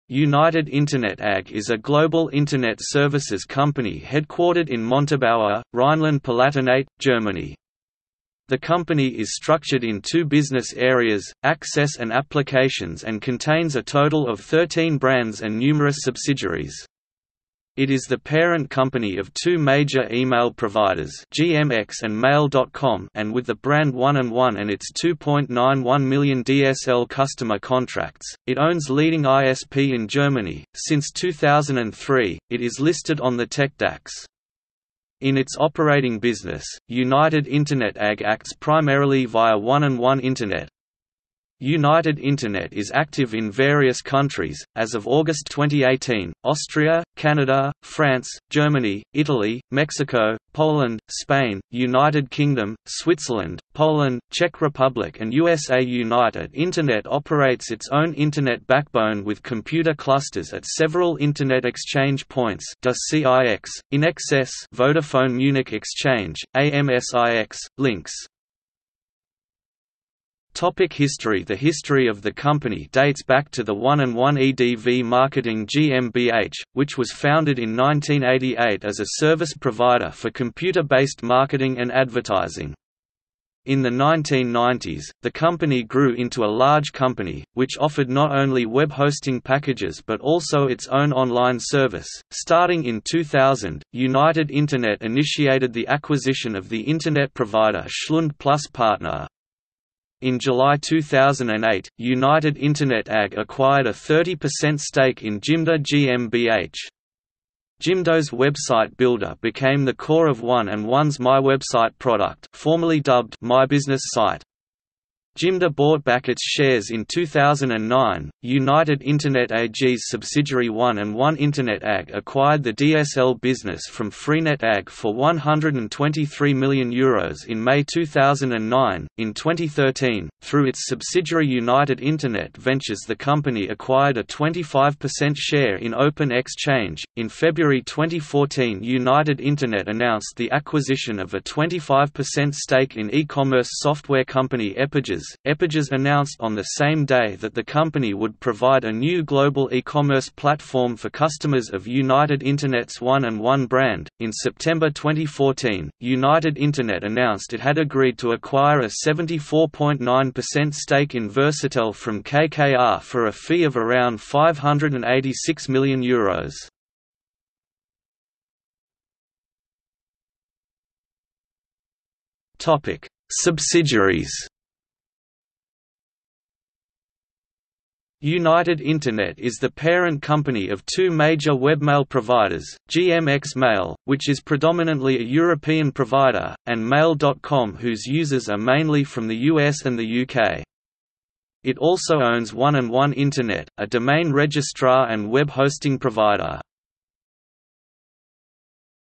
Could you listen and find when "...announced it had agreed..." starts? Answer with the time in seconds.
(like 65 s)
157 s.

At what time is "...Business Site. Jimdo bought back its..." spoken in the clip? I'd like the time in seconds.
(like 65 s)
113 s.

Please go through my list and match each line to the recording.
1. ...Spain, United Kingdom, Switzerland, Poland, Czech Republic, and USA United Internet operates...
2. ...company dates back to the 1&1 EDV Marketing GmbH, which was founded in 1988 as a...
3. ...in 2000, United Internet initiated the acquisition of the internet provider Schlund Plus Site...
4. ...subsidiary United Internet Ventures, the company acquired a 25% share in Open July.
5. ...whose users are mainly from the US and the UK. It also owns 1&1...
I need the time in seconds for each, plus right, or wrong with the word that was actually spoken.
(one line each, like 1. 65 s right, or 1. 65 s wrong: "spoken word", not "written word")
1. 51 s right
2. 72 s right
3. 92 s wrong: "Partner", not "Site"
4. 130 s wrong: "Exchange", not "July"
5. 187 s right.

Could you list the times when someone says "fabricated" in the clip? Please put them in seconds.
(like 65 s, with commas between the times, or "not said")
not said.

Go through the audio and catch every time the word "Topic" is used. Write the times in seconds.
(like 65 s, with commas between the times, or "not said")
70 s, 172 s.